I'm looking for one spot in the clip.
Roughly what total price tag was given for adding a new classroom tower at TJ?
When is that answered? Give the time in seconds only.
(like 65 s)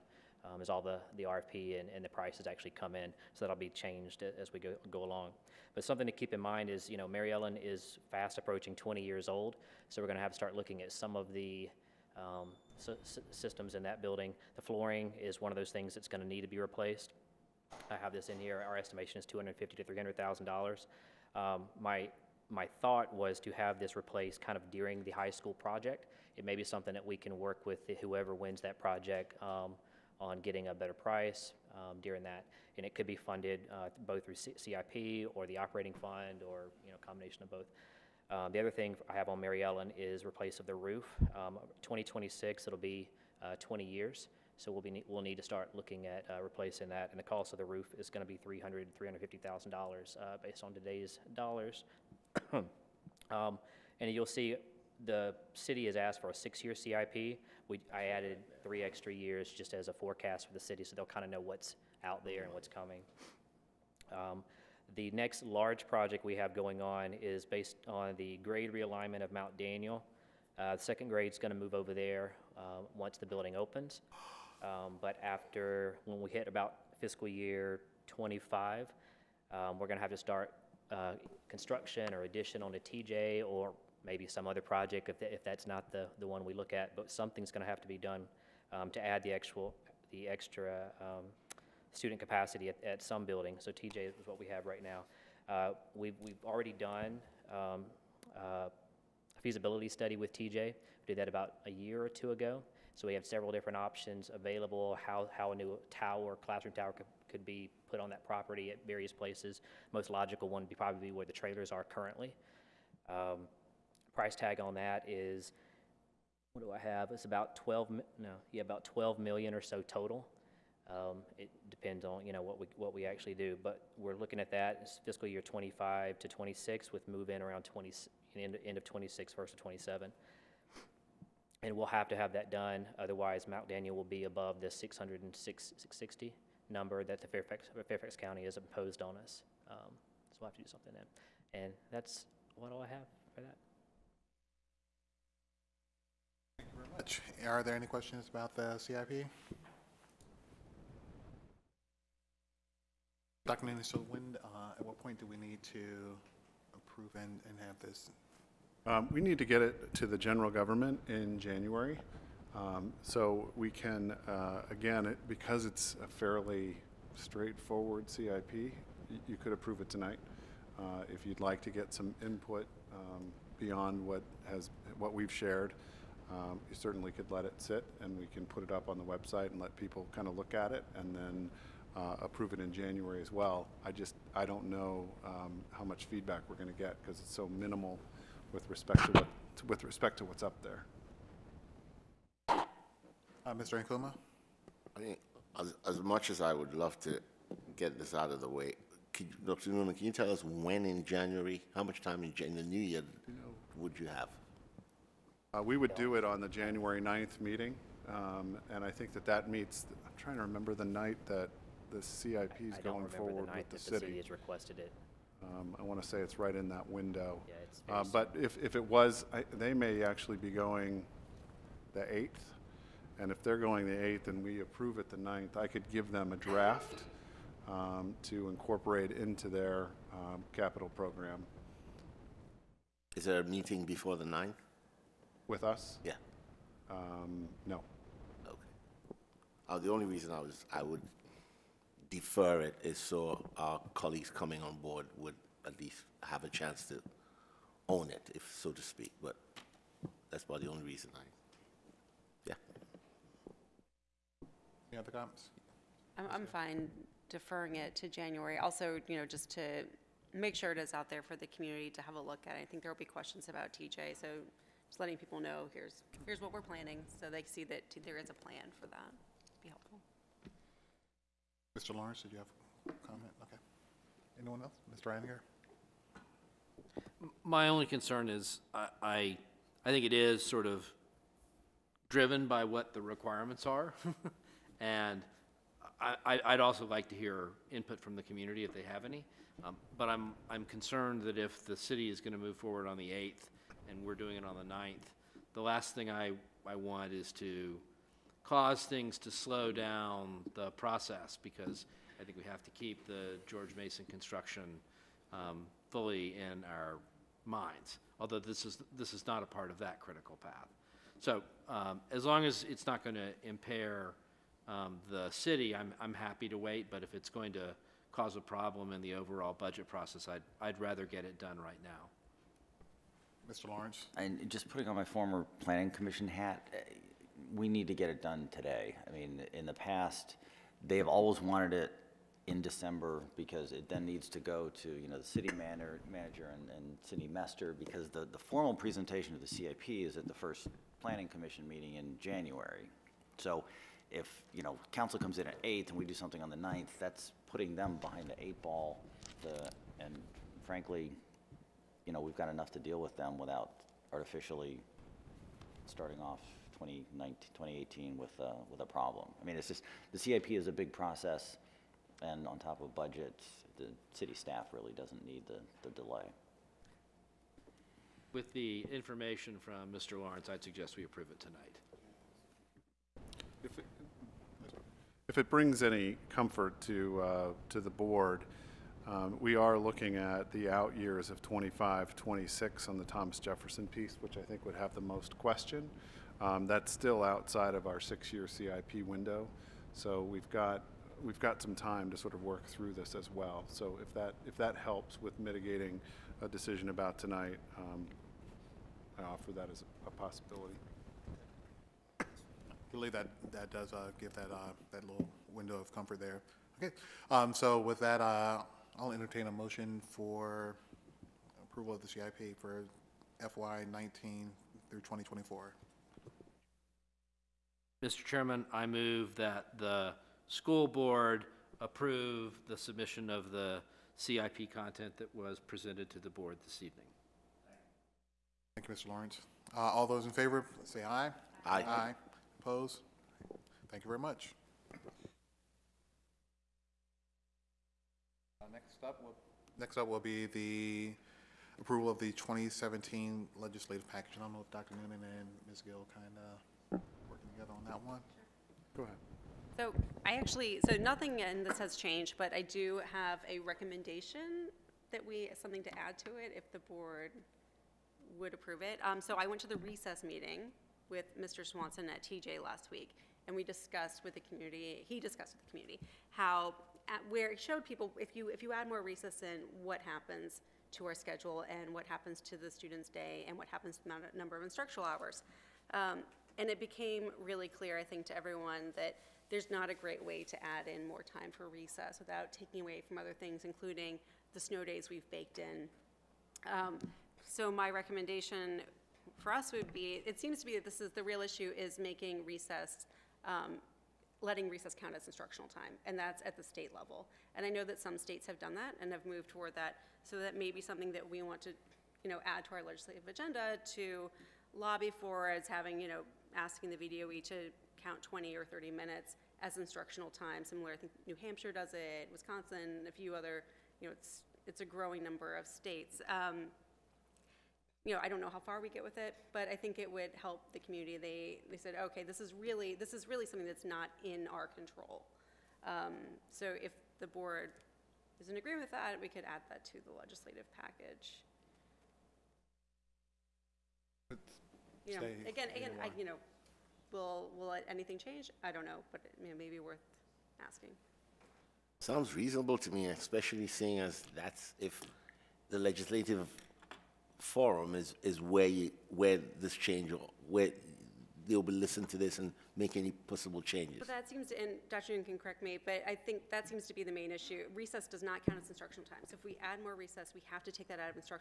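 118 s.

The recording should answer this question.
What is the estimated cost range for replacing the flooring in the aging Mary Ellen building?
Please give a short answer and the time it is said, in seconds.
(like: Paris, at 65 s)
250 to 300 thousand dollars, at 19 s.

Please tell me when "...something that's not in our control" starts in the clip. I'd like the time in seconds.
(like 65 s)
523 s.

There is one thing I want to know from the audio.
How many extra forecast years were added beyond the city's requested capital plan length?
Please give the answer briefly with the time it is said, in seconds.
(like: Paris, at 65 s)
three, at 58 s.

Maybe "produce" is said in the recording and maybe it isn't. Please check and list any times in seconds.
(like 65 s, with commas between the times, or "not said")
not said.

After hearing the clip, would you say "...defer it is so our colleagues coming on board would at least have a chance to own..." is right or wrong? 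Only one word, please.
right.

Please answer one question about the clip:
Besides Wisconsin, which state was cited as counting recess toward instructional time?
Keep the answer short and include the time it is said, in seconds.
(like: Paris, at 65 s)
New Hampshire, at 511 s.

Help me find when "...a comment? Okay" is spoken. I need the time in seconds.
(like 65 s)
272 s.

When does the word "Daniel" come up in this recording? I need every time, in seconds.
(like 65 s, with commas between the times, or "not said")
69 s, 133 s.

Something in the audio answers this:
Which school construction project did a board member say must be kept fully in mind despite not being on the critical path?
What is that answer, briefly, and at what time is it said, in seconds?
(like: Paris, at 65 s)
George Mason, at 303 s.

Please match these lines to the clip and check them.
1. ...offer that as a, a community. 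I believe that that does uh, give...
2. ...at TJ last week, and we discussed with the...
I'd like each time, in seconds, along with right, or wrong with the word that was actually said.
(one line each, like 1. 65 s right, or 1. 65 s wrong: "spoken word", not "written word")
1. 399 s wrong: "possibility", not "community"
2. 462 s right.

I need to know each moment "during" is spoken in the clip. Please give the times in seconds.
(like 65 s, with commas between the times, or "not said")
24 s, 32 s.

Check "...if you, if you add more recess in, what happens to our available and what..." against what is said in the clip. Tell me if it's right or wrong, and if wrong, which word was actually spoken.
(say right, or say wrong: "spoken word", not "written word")
wrong: "schedule", not "available".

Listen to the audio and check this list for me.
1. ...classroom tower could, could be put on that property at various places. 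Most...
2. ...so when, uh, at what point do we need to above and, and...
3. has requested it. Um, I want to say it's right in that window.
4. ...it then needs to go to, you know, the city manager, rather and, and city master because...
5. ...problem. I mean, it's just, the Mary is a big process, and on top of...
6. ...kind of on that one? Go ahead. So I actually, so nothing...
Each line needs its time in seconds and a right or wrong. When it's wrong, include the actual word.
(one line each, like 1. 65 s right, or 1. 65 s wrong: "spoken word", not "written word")
1. 106 s right
2. 153 s wrong: "approve", not "above"
3. 214 s right
4. 333 s wrong: "manager", not "rather"
5. 358 s wrong: "CIP", not "Mary"
6. 446 s right.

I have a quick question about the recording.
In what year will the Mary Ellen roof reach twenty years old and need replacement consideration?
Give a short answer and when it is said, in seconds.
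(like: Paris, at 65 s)
2026, at 41 s.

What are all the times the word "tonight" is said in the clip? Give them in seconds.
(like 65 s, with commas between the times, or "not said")
169 s, 371 s, 397 s.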